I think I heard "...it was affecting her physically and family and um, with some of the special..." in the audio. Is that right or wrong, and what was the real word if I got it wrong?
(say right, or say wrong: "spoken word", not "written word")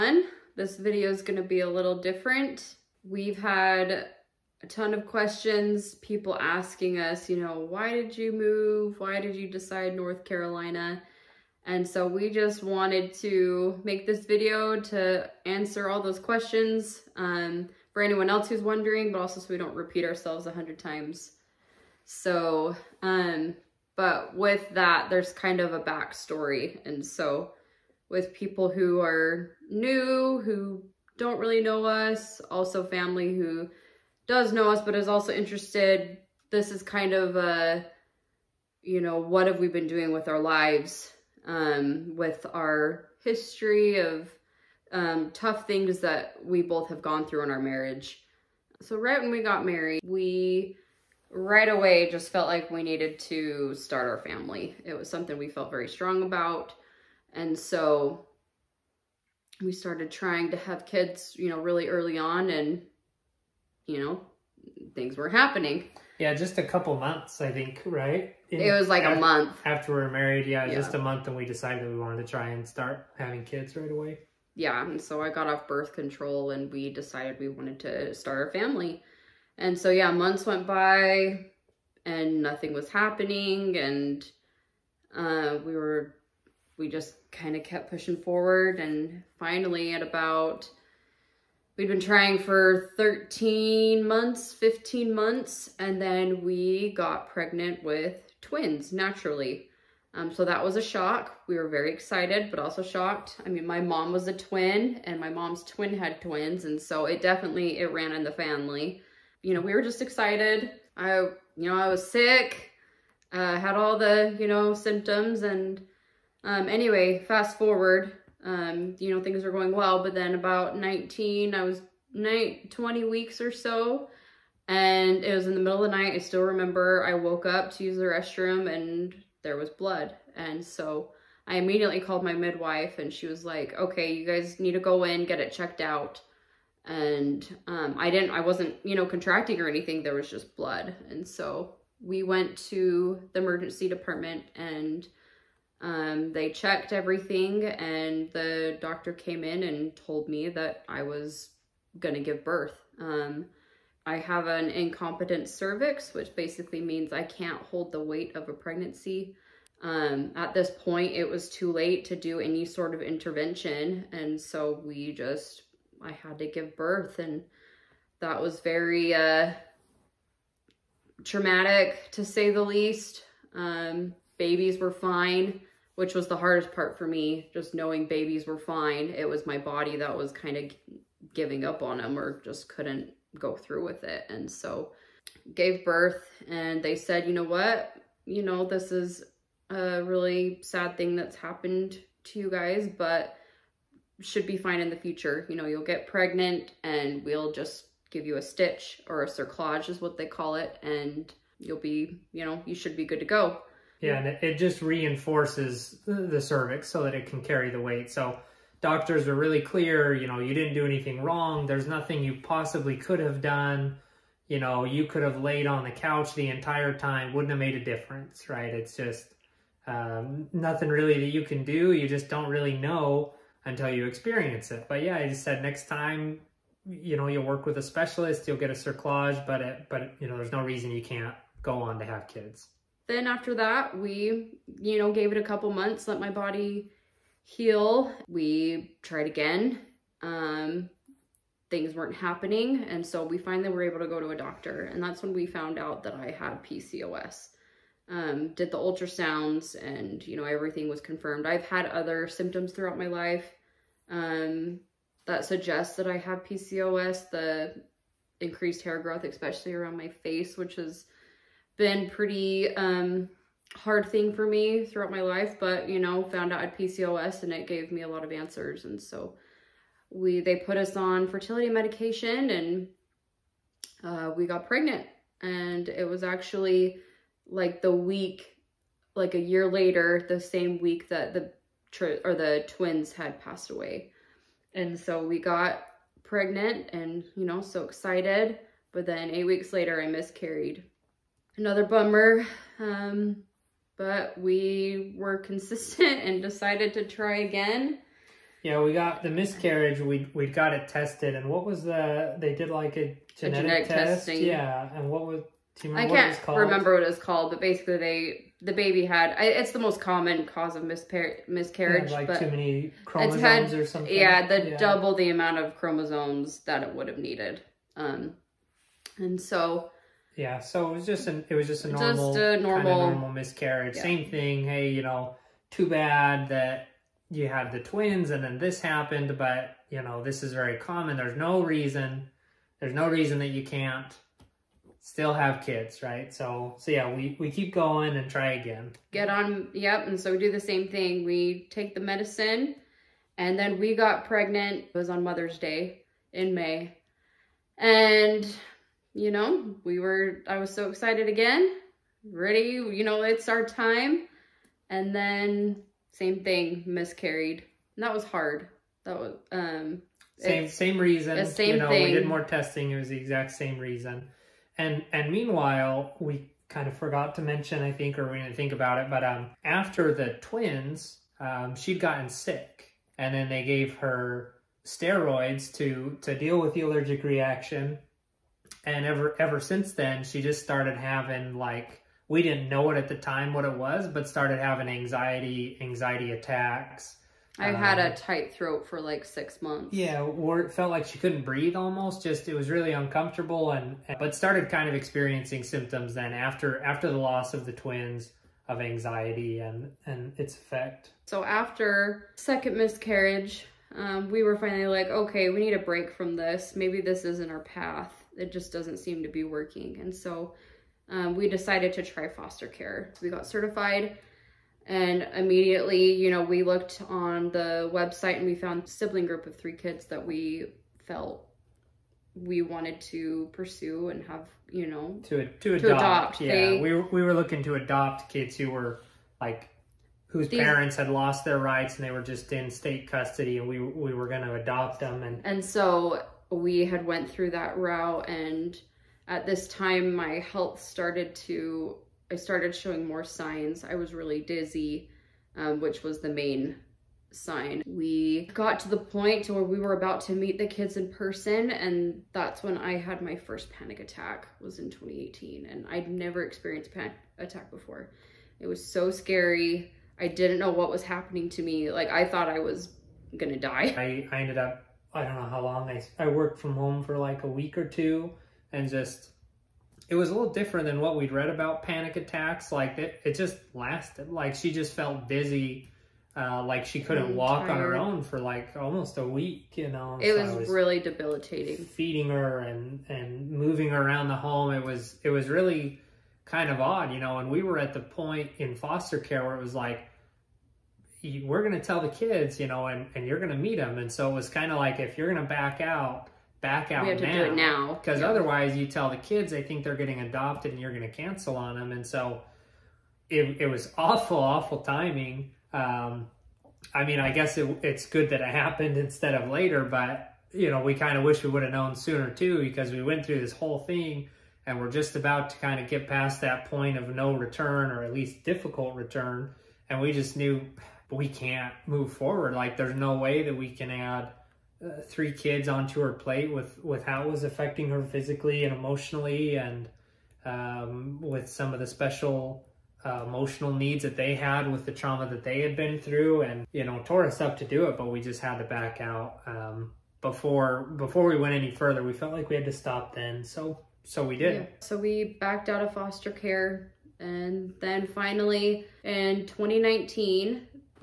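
wrong: "emotionally", not "family".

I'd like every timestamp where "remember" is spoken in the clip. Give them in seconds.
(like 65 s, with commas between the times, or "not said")
126 s, 306 s.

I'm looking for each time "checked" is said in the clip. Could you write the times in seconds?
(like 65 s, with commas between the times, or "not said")
135 s, 146 s.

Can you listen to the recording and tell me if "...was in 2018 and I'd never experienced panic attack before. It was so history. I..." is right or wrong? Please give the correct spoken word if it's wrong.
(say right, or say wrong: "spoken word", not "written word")
wrong: "scary", not "history".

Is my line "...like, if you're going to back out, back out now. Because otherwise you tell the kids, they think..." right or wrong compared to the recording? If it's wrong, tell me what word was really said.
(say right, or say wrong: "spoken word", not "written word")
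right.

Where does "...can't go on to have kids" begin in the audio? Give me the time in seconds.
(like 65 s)
231 s.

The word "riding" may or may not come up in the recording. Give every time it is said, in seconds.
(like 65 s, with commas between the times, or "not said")
not said.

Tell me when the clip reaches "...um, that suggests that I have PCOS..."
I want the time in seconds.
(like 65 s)
254 s.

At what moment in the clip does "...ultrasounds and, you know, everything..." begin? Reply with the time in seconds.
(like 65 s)
248 s.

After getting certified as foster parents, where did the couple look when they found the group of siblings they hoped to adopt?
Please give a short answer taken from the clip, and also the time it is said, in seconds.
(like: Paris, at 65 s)
The website, at 417 s.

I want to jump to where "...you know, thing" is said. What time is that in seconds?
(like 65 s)
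361 s.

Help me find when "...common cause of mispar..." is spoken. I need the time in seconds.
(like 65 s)
310 s.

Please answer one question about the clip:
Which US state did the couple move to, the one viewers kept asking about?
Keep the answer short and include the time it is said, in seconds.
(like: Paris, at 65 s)
North Carolina, at 9 s.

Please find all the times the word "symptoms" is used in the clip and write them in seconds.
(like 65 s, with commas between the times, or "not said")
114 s, 252 s, 395 s.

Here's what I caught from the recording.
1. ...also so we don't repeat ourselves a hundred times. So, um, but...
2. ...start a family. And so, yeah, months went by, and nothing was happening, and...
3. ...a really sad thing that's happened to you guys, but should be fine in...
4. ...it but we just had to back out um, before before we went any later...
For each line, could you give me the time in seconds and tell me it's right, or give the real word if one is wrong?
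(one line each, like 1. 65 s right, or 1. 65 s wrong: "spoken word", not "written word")
1. 19 s right
2. 78 s right
3. 189 s right
4. 537 s wrong: "further", not "later".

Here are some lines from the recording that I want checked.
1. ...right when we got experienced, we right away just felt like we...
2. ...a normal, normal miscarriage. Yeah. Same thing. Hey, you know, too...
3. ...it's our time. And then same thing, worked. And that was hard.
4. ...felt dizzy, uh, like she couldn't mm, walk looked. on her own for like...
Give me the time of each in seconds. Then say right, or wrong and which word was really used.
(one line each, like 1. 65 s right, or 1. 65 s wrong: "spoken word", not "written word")
1. 48 s wrong: "married", not "experienced"
2. 322 s right
3. 353 s wrong: "miscarried", not "worked"
4. 474 s wrong: "tired", not "looked".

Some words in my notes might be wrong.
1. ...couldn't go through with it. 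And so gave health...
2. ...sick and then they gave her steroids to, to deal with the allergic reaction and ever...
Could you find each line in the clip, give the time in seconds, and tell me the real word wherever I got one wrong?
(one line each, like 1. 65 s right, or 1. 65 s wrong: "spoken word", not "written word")
1. 182 s wrong: "birth", not "health"
2. 372 s right.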